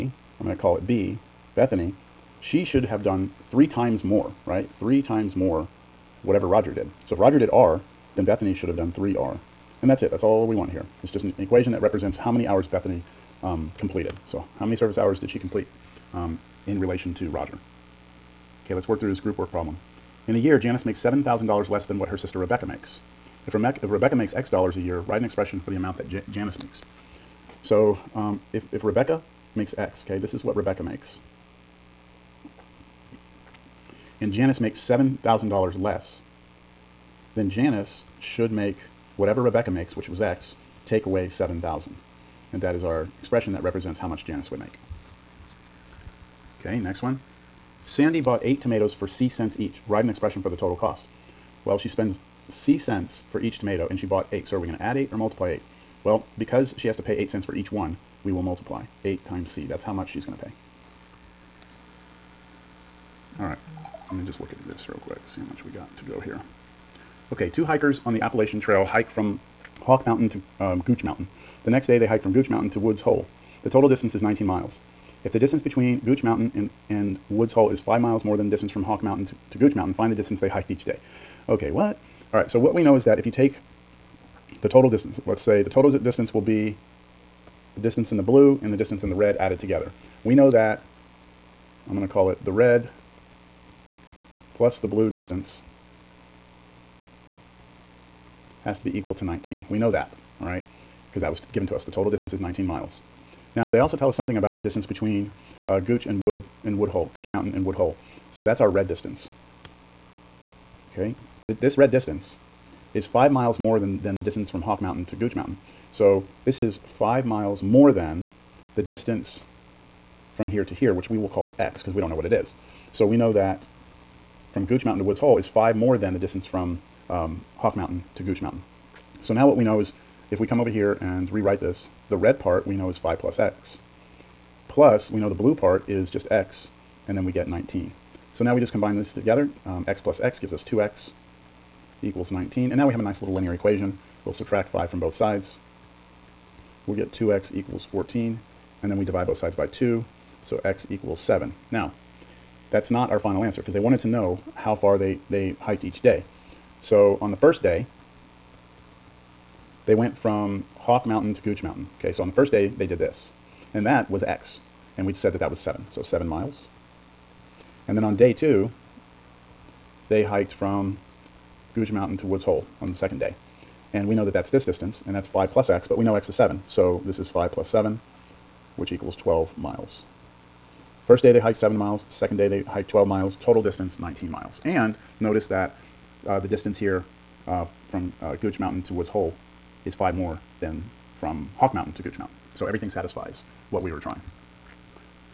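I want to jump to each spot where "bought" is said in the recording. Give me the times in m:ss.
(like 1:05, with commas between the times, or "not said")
0:48, 0:54.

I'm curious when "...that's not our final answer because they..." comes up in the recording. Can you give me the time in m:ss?
2:32.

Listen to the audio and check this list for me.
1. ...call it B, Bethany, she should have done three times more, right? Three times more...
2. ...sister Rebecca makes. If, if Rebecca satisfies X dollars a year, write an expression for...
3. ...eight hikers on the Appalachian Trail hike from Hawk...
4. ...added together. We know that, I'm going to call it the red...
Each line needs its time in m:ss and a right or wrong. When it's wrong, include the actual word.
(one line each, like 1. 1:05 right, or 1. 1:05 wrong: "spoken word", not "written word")
1. 0:00 right
2. 0:22 wrong: "makes", not "satisfies"
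3. 1:07 wrong: "two", not "eight"
4. 1:29 right.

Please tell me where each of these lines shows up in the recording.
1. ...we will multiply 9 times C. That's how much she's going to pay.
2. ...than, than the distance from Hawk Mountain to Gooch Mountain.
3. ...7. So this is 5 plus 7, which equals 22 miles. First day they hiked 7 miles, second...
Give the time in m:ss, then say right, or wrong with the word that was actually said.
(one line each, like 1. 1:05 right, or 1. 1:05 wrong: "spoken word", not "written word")
1. 0:58 wrong: "8", not "9"
2. 1:53 right
3. 2:56 wrong: "12", not "22".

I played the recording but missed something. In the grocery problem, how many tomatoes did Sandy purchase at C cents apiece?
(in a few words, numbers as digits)
8.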